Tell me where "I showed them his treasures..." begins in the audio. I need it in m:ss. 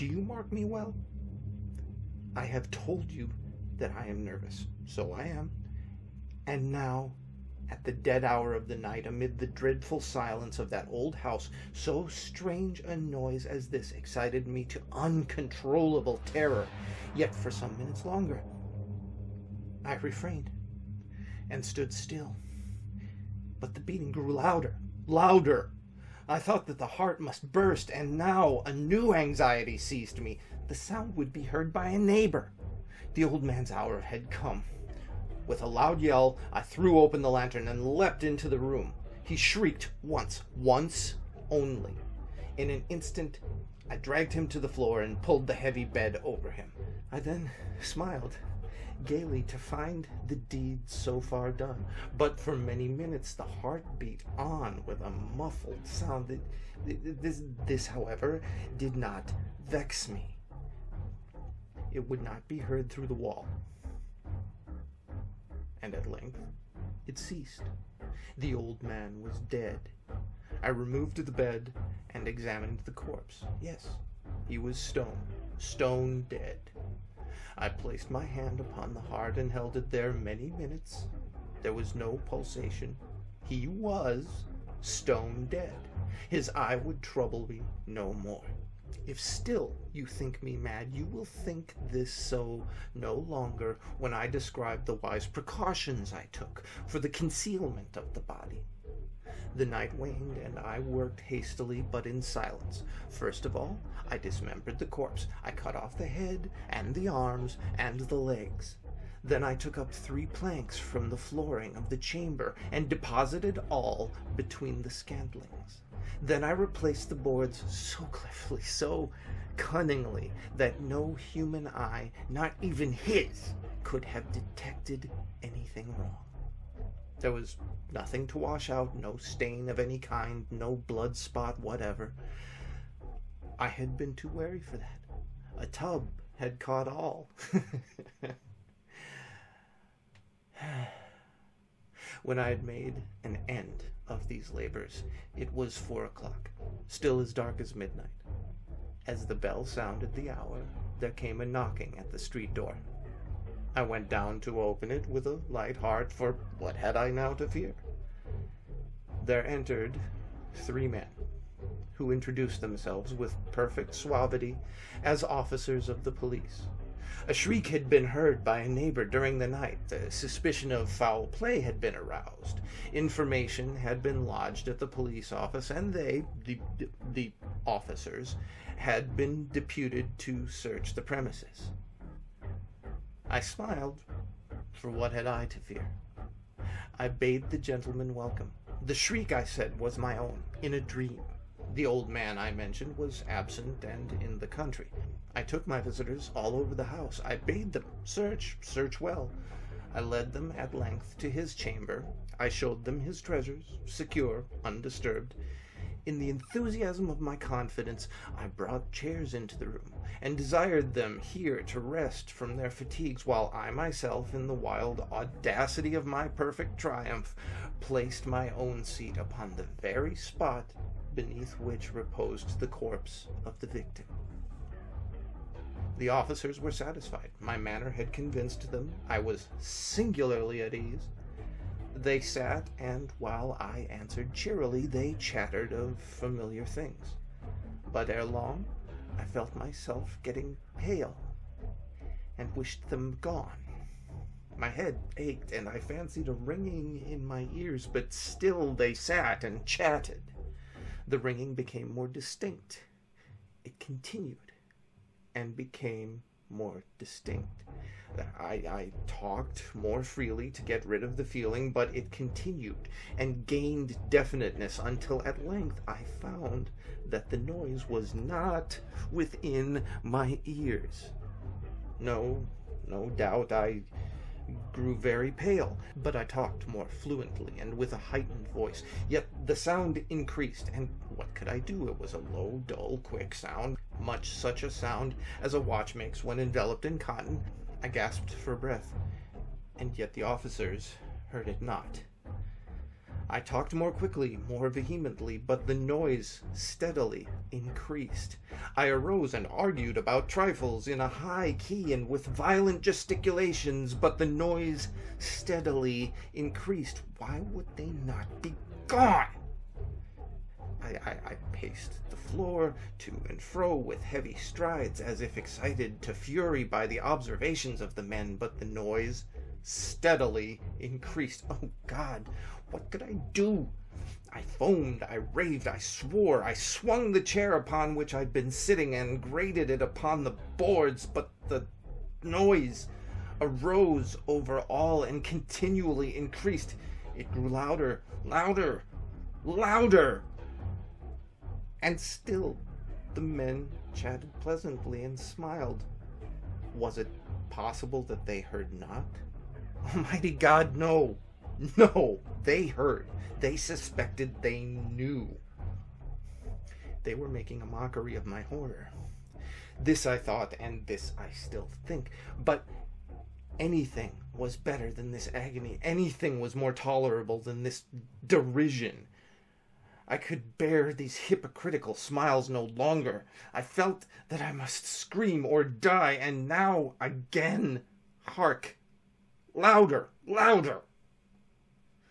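3:22.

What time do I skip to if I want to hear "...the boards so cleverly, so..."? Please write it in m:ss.
1:57.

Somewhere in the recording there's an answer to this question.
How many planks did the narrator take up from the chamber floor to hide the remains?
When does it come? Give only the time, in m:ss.
1:49.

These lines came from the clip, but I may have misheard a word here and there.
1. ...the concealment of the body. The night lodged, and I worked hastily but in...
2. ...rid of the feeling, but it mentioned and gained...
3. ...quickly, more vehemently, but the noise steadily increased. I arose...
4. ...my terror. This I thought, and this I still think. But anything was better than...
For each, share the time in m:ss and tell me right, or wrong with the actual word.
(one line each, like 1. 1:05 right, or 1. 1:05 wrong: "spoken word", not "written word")
1. 1:37 wrong: "waned", not "lodged"
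2. 4:20 wrong: "continued", not "mentioned"
3. 4:53 right
4. 5:58 wrong: "horror", not "terror".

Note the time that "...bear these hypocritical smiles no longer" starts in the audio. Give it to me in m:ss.
6:10.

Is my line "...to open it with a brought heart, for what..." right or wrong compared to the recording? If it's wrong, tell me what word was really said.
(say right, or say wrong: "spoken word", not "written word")
wrong: "light", not "brought".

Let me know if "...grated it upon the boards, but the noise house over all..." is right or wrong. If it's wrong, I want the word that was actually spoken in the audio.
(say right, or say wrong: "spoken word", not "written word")
wrong: "arose", not "house".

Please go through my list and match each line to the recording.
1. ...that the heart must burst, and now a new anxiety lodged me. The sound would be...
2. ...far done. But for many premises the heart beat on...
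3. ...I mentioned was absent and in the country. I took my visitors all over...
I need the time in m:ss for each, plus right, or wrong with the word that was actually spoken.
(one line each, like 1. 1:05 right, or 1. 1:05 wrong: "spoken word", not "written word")
1. 0:26 wrong: "seized", not "lodged"
2. 0:51 wrong: "minutes", not "premises"
3. 3:12 right.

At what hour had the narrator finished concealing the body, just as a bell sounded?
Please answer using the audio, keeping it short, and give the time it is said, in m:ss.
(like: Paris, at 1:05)
4 o'clock, at 2:25.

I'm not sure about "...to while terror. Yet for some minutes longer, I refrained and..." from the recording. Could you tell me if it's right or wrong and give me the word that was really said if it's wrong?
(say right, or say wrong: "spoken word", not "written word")
wrong: "uncontrollable", not "while".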